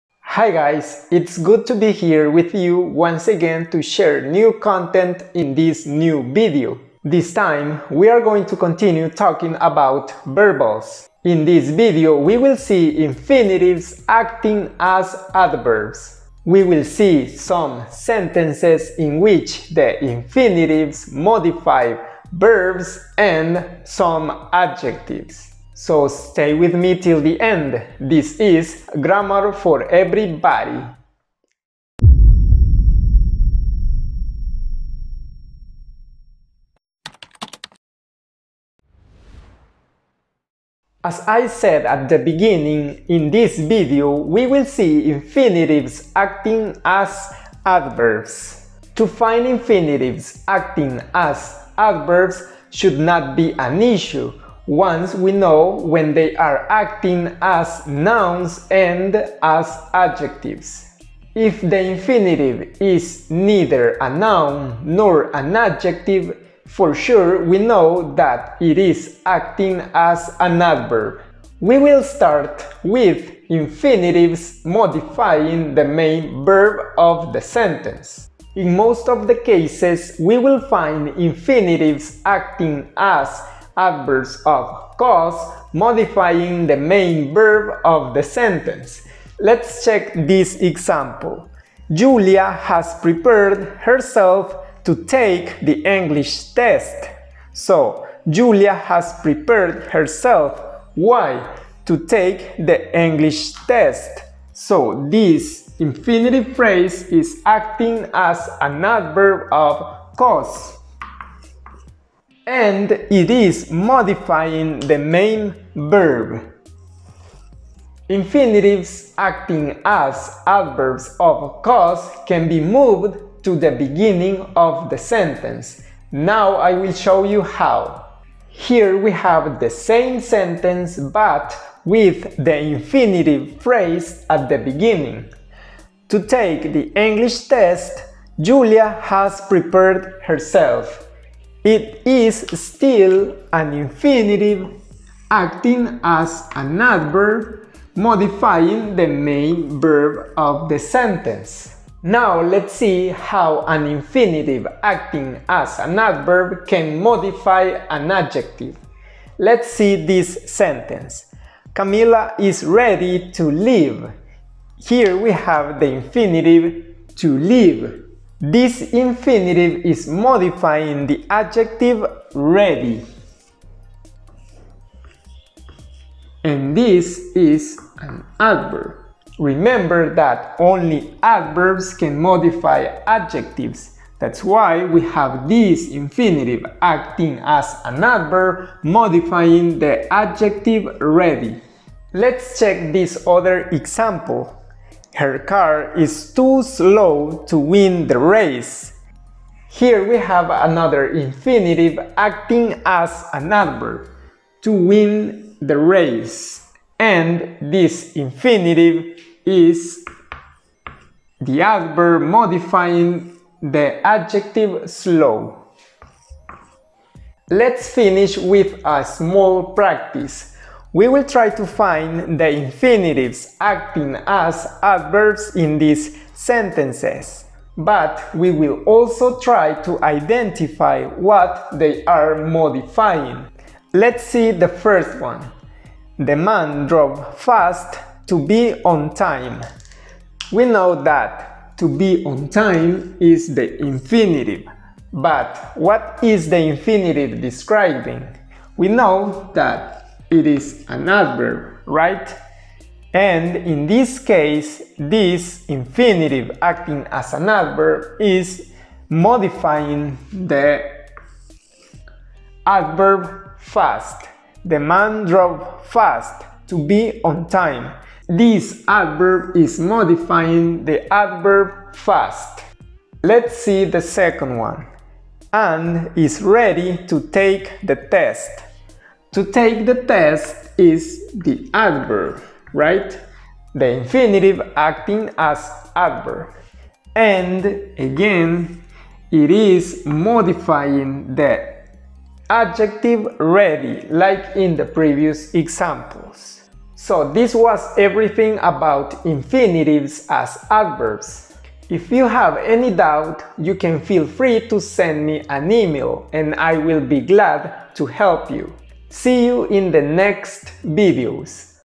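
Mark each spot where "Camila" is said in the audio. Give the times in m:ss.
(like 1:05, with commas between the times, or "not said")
2:41.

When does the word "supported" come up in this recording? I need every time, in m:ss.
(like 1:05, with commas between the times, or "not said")
not said.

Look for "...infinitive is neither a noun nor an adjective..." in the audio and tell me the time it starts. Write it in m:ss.
1:01.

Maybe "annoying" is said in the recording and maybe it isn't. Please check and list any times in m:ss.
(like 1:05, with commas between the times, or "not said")
not said.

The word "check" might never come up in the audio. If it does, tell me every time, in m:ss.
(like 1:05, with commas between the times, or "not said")
1:29, 3:12.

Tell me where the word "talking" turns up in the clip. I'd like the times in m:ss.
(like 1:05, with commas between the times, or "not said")
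0:09.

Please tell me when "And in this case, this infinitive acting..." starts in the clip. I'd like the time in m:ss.
4:13.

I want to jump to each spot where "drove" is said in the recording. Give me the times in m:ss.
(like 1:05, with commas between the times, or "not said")
3:56, 4:25.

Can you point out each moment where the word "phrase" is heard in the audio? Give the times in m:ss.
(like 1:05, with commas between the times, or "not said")
1:46, 2:13.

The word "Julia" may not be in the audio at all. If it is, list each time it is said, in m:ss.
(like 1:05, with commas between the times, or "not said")
1:31, 1:38, 2:18.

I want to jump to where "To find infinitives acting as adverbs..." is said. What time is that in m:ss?
0:48.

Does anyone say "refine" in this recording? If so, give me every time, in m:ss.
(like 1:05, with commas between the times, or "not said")
not said.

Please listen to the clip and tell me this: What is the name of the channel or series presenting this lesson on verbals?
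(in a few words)
Grammar for Everybody.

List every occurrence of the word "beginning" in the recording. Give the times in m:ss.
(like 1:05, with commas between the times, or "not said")
0:42, 2:03, 2:14.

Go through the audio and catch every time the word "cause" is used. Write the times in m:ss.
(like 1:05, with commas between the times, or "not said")
1:24, 1:50, 2:01.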